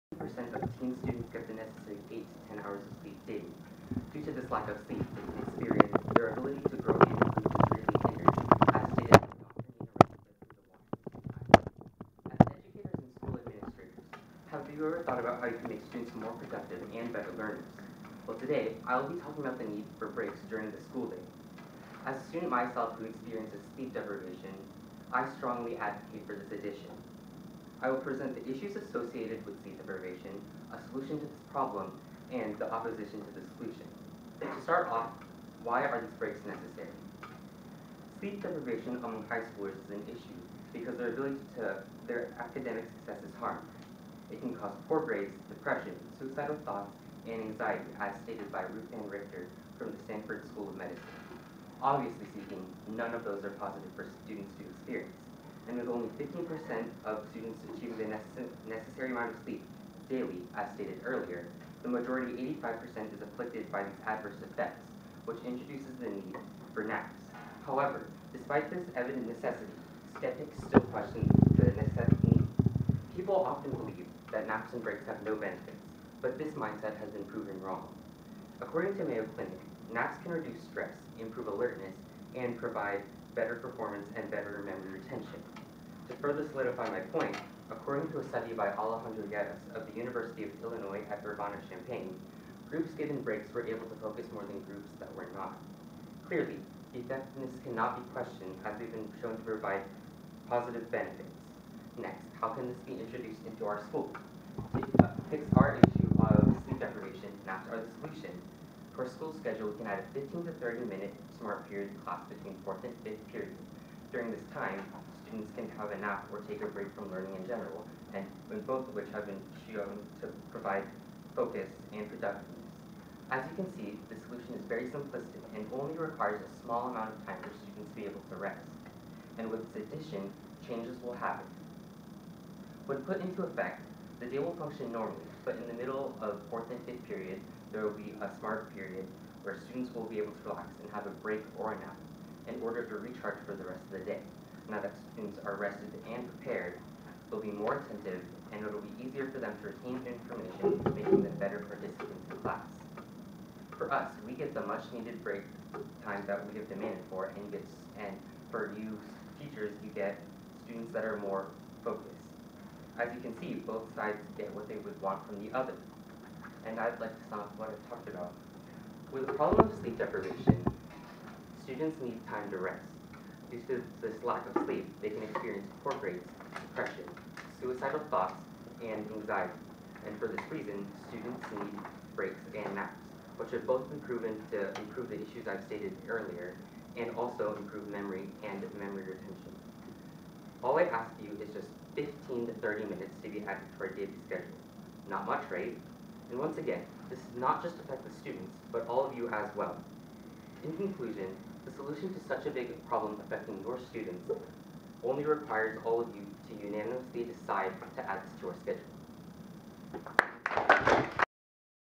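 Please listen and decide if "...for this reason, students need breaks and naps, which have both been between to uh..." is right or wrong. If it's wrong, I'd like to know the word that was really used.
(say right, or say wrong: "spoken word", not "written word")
wrong: "proven", not "between".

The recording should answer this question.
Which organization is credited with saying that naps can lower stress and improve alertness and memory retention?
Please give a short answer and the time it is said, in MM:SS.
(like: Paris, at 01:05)
Mayo Clinic, at 01:19.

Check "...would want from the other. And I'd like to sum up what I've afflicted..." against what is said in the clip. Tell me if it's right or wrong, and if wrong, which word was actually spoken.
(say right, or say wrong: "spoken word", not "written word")
wrong: "talked", not "afflicted".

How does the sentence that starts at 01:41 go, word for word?
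Next, how can this be introduced into our school?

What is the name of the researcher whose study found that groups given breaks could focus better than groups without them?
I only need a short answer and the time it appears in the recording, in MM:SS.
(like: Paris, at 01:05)
Alejandro Guedes, at 01:28.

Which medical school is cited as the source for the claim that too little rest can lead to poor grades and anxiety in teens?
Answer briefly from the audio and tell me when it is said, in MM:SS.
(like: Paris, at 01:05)
Stanford School of Medicine, at 00:50.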